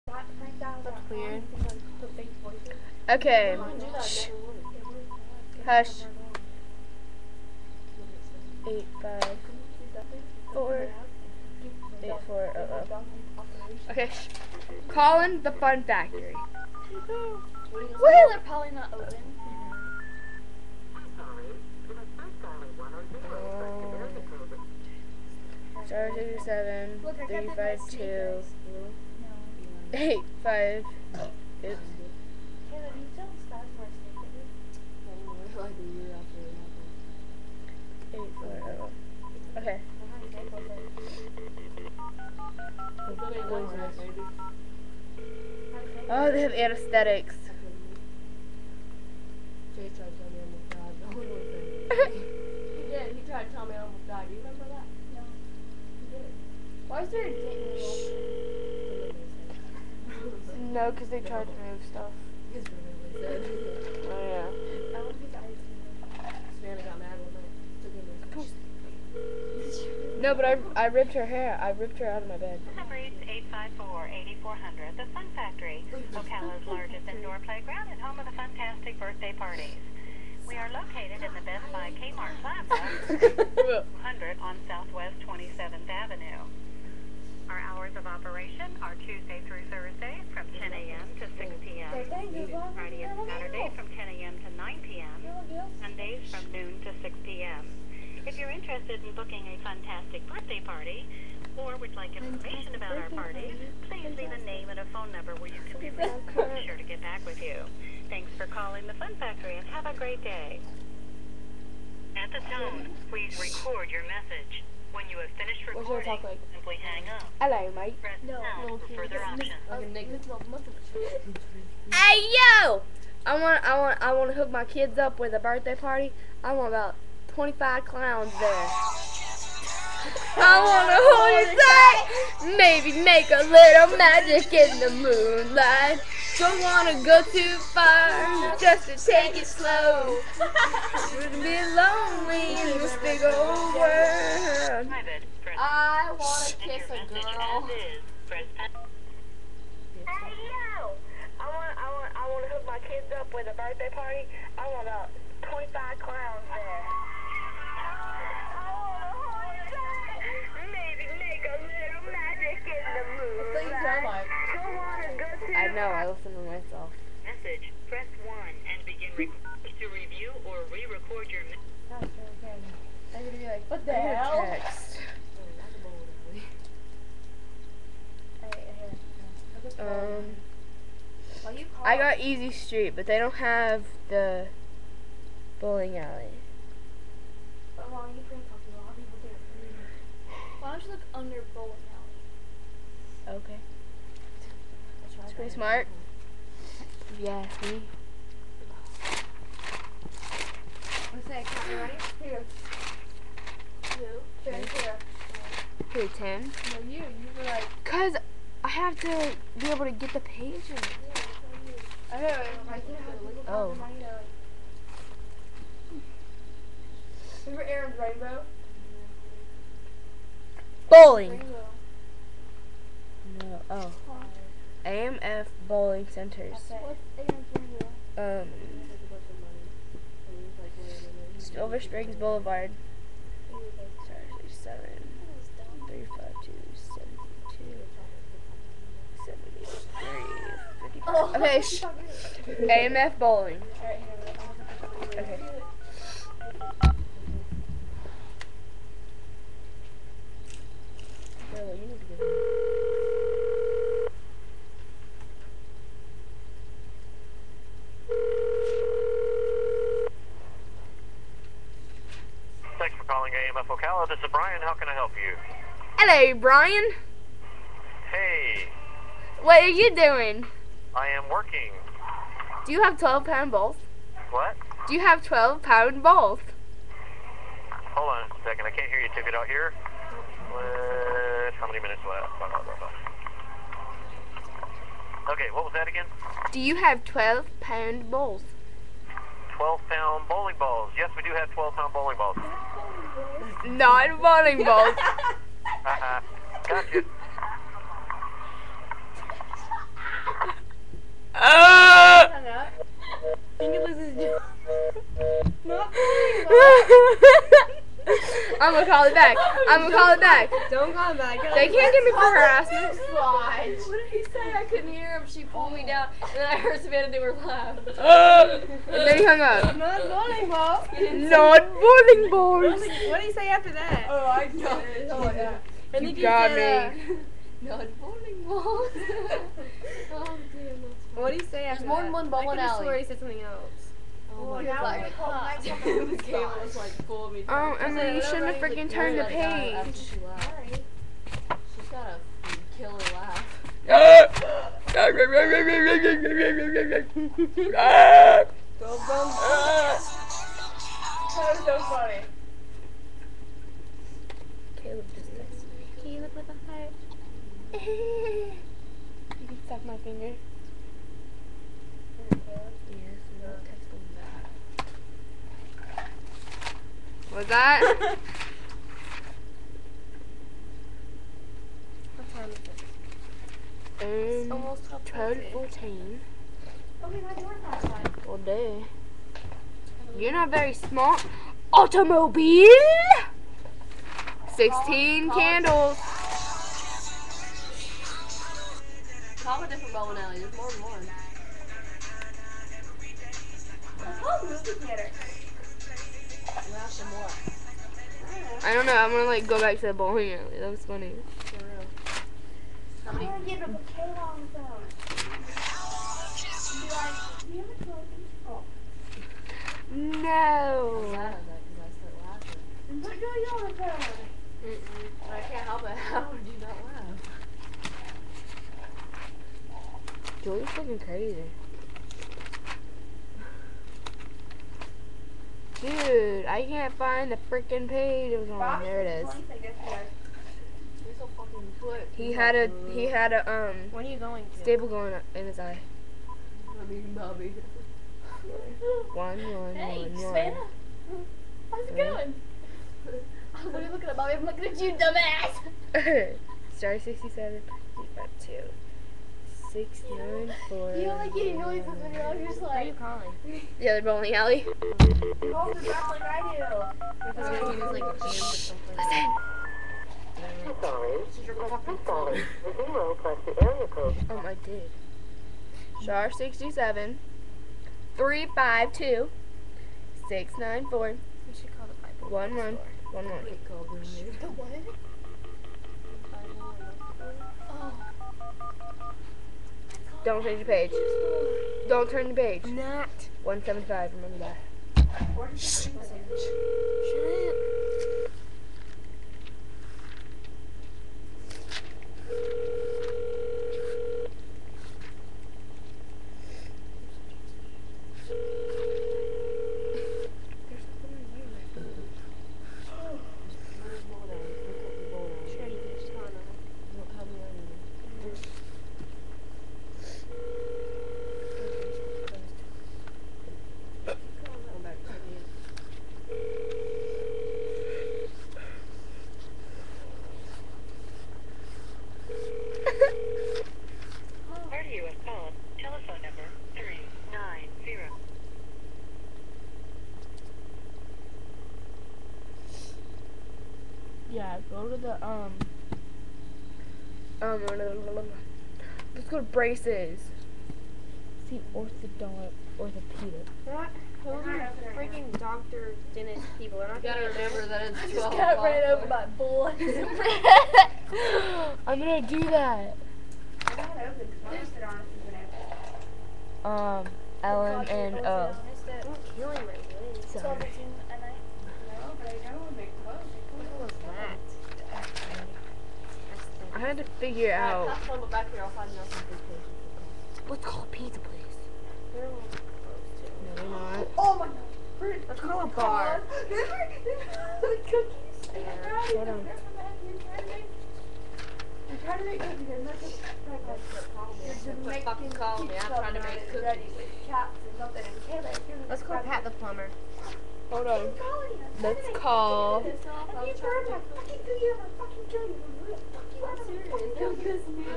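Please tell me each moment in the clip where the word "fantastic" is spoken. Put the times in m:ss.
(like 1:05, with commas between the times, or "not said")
1:18, 1:39.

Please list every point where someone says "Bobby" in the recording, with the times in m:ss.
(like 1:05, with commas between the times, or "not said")
7:17, 7:24.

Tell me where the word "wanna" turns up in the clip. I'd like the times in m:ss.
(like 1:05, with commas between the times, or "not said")
2:10, 2:16, 2:26.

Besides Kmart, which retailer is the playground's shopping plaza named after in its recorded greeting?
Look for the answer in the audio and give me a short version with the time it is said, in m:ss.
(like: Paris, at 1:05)
Best Buy, at 1:21.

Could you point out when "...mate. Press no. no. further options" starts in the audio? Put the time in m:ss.
1:57.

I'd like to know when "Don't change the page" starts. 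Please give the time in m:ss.
8:00.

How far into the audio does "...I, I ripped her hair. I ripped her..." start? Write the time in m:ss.
1:10.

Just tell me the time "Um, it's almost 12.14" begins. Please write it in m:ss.
6:14.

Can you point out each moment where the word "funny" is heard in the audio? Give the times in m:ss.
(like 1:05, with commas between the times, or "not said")
5:51, 6:40.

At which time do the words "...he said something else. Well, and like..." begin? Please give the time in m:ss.
5:32.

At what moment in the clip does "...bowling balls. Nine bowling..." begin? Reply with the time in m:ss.
4:51.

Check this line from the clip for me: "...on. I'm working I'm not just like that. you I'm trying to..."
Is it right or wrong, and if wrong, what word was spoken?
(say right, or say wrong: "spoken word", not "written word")
wrong: "trying", not "working".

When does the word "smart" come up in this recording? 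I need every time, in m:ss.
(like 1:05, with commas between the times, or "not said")
3:15, 6:20.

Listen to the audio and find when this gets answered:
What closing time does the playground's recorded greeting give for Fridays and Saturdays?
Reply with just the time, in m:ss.
1:34.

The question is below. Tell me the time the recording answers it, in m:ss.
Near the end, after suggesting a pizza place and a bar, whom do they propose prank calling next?
9:49.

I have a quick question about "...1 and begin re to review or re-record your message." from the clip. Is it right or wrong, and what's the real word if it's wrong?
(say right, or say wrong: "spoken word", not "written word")
right.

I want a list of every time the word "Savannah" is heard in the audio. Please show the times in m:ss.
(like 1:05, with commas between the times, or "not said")
5:16, 7:20.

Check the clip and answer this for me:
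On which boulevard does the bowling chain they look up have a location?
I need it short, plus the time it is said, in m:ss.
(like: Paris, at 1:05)
Silver Springs Boulevard, at 3:51.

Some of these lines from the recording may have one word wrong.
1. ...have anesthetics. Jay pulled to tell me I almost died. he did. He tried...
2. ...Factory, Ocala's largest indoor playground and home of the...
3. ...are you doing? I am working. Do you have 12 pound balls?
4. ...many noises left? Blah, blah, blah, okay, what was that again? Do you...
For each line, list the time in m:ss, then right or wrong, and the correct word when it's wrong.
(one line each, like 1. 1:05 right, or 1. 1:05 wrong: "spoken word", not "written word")
1. 0:46 wrong: "tried", not "pulled"
2. 1:15 right
3. 4:29 right
4. 4:41 wrong: "minutes", not "noises".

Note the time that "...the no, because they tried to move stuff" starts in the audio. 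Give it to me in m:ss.
0:57.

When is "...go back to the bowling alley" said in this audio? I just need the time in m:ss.
6:39.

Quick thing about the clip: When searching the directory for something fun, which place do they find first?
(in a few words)
Easy Street.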